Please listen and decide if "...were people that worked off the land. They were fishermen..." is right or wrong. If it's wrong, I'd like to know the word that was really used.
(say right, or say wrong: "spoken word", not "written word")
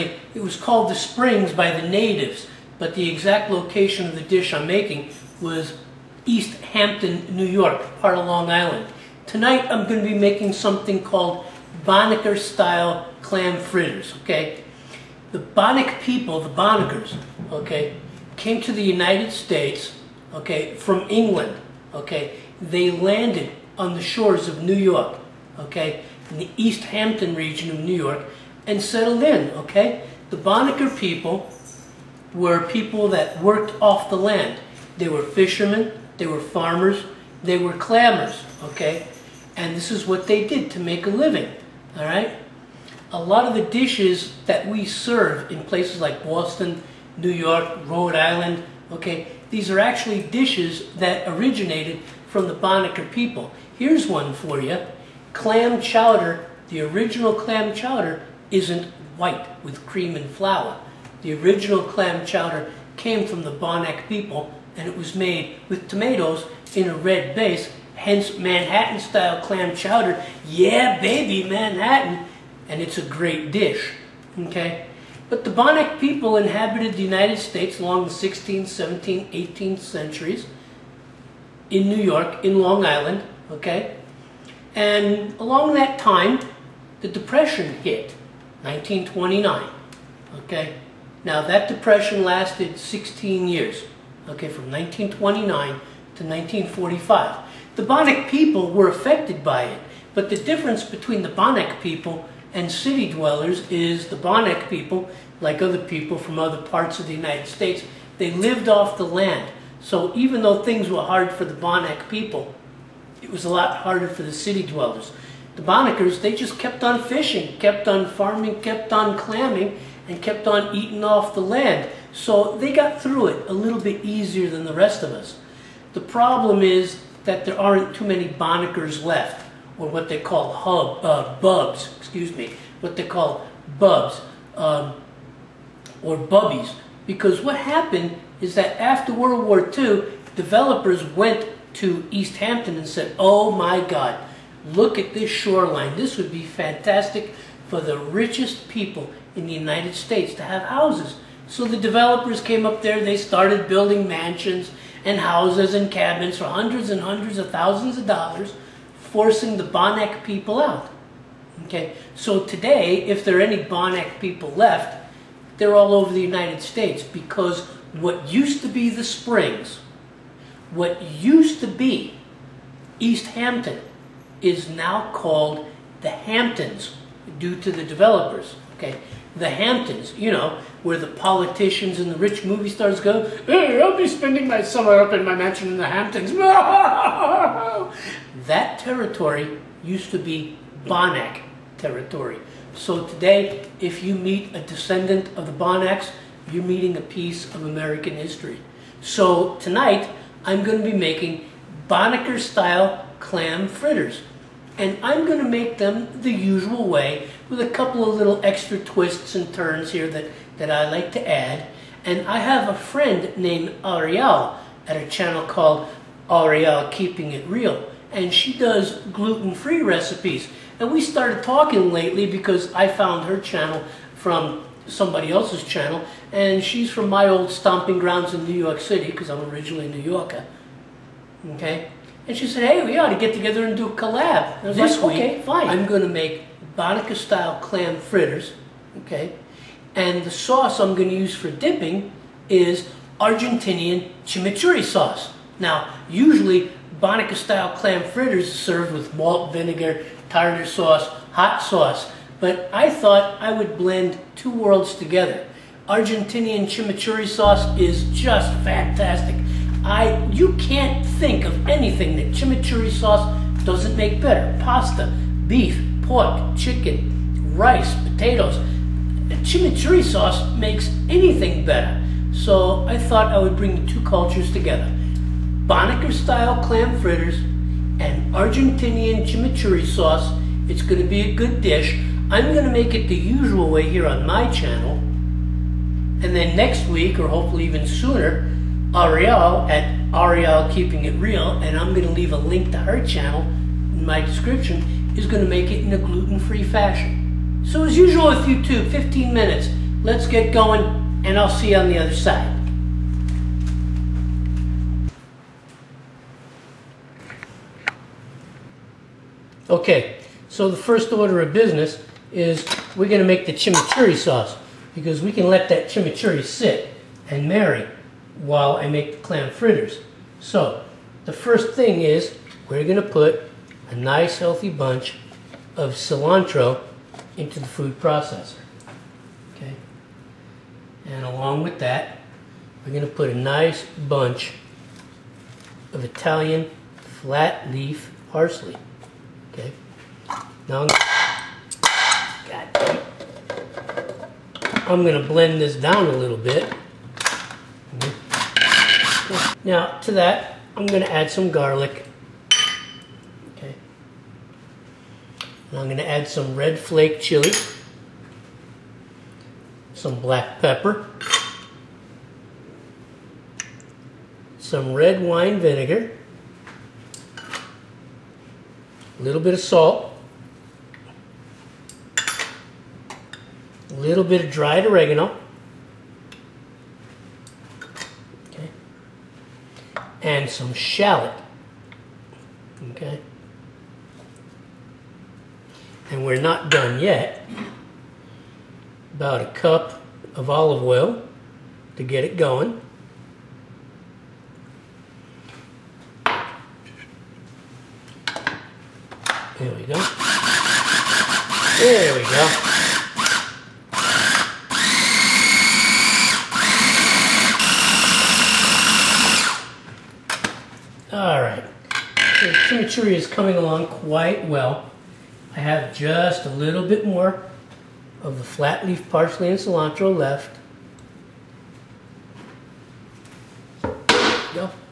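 right.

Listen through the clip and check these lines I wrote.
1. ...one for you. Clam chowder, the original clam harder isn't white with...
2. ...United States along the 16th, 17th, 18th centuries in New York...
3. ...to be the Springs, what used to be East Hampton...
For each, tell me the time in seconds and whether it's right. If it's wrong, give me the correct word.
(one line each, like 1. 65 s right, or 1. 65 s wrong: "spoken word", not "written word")
1. 54 s wrong: "chowder", not "harder"
2. 77 s right
3. 168 s right.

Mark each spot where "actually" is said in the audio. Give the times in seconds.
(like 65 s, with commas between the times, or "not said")
49 s.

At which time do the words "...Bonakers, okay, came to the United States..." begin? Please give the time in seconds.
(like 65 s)
16 s.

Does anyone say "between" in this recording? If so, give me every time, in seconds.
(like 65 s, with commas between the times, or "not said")
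100 s.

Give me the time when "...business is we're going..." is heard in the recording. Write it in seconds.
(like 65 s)
311 s.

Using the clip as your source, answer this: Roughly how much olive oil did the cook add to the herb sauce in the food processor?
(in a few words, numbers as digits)
1 cup.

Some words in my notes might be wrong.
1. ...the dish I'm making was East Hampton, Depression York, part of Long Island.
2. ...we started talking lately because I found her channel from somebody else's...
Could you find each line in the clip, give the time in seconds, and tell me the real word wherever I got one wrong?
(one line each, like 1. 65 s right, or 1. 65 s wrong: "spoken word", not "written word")
1. 4 s wrong: "New", not "Depression"
2. 220 s right.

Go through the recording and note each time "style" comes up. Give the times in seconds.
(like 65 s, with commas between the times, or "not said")
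12 s, 68 s, 201 s, 237 s, 247 s, 276 s.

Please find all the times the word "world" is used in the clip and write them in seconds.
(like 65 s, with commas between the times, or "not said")
139 s, 254 s.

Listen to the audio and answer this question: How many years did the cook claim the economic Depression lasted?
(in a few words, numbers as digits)
16 years.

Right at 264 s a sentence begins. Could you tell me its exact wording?
Pasta, beef, pork, chicken, rice, potatoes.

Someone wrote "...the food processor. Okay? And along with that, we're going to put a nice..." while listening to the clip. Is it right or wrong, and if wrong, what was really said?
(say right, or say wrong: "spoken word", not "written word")
right.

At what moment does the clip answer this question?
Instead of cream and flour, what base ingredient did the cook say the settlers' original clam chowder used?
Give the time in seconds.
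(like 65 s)
65 s.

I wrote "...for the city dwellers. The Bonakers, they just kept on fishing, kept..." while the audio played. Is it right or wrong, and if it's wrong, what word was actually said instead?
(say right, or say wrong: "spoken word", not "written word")
right.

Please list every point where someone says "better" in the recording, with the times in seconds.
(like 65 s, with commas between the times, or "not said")
264 s, 271 s.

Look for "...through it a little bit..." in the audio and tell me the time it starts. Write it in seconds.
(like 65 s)
123 s.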